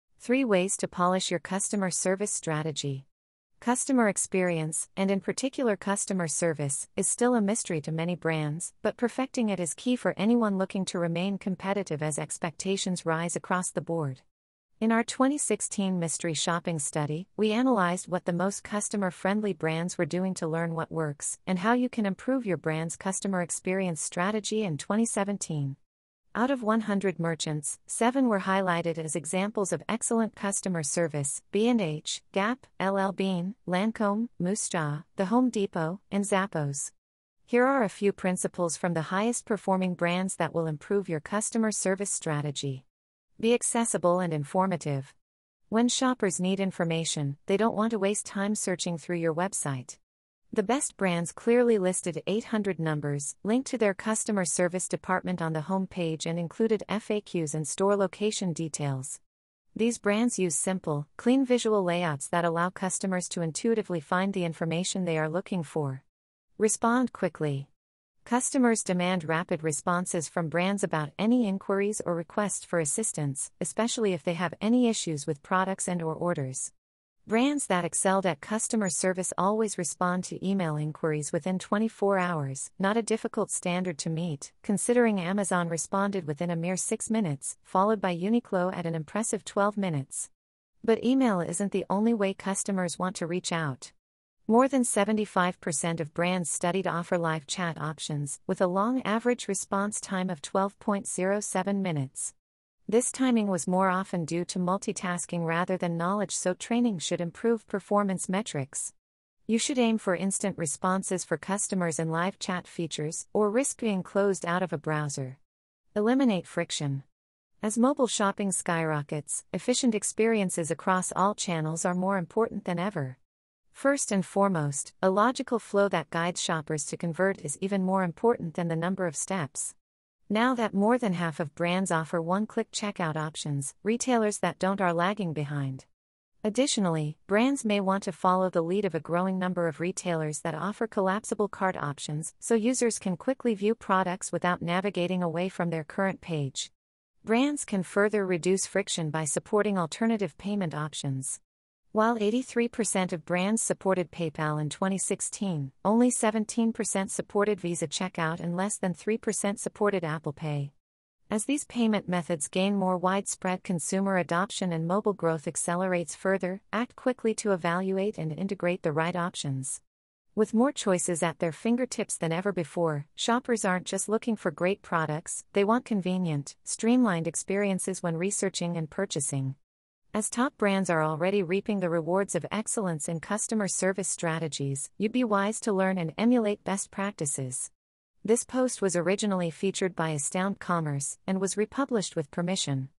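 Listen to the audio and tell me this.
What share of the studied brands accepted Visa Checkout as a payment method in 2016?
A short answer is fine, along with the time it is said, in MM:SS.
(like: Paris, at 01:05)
17%, at 02:36.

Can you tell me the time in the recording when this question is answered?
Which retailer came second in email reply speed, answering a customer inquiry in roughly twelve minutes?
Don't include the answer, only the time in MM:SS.
01:28.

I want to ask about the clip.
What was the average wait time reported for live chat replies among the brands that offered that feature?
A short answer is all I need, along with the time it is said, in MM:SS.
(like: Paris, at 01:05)
12.07 minutes, at 01:40.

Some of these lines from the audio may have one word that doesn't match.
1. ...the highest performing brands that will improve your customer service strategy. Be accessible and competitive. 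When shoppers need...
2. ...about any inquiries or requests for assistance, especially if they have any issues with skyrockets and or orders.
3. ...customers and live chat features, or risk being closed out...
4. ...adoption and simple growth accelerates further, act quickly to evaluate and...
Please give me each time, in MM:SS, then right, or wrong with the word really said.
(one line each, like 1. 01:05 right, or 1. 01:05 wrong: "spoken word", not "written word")
1. 00:38 wrong: "informative", not "competitive"
2. 01:10 wrong: "products", not "skyrockets"
3. 01:51 right
4. 02:44 wrong: "mobile", not "simple".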